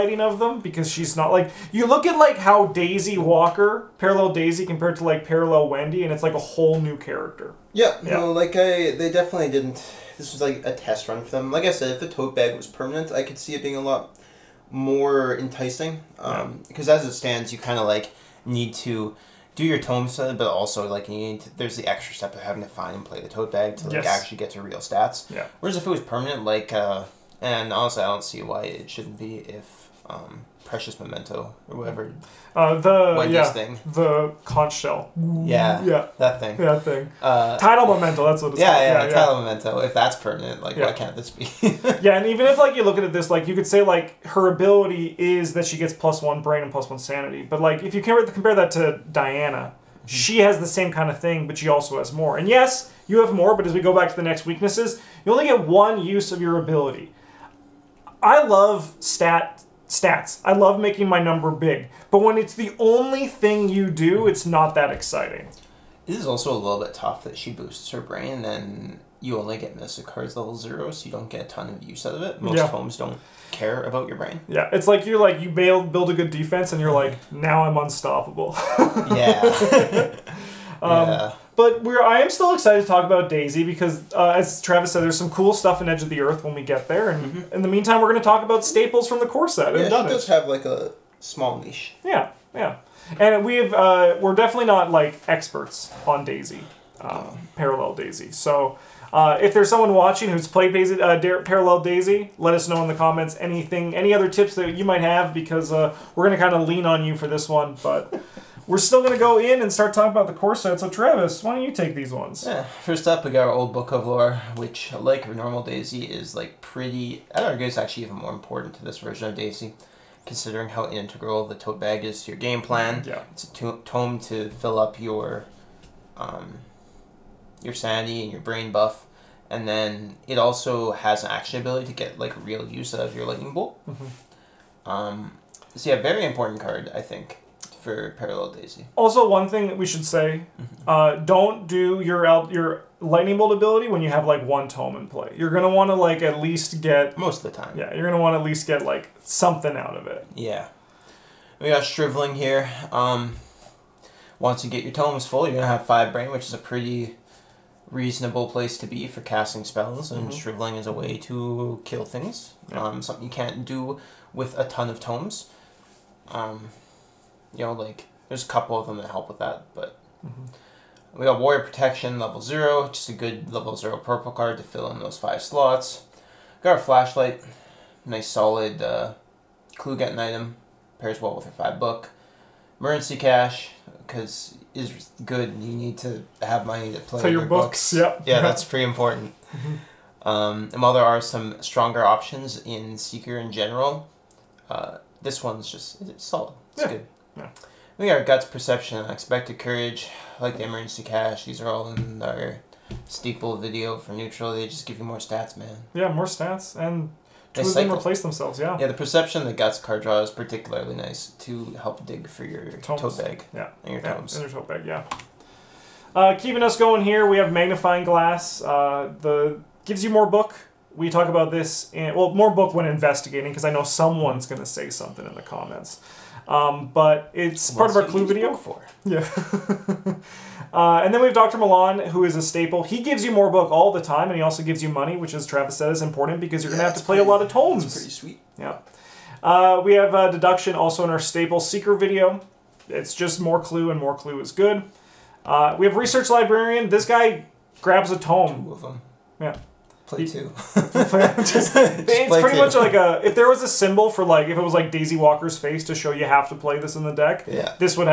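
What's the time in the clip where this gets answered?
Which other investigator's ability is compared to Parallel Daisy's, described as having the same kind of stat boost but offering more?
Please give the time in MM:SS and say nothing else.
00:49.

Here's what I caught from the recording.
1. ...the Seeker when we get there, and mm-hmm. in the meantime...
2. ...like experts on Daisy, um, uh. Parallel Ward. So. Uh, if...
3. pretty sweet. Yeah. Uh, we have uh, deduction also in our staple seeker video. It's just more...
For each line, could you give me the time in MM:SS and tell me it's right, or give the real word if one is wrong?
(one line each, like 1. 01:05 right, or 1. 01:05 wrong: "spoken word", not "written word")
1. 01:26 wrong: "Earth", not "Seeker"
2. 01:34 wrong: "Daisy", not "Ward"
3. 03:57 right.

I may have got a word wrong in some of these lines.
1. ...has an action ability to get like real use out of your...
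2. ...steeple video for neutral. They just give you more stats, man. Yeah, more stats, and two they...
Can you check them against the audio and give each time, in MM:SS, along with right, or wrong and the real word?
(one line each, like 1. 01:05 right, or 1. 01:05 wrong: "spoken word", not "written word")
1. 02:10 right
2. 03:23 right.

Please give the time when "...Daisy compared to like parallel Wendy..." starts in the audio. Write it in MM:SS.
00:04.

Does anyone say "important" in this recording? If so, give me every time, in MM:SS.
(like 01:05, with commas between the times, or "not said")
01:58, 02:16, 03:08, 03:56.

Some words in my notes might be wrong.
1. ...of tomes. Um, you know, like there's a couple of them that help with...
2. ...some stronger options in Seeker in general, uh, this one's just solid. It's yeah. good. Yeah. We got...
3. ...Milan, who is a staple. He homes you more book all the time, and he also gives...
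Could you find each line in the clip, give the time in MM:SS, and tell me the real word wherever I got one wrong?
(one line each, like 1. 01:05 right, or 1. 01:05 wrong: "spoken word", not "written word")
1. 02:44 right
2. 03:11 right
3. 03:51 wrong: "gives", not "homes".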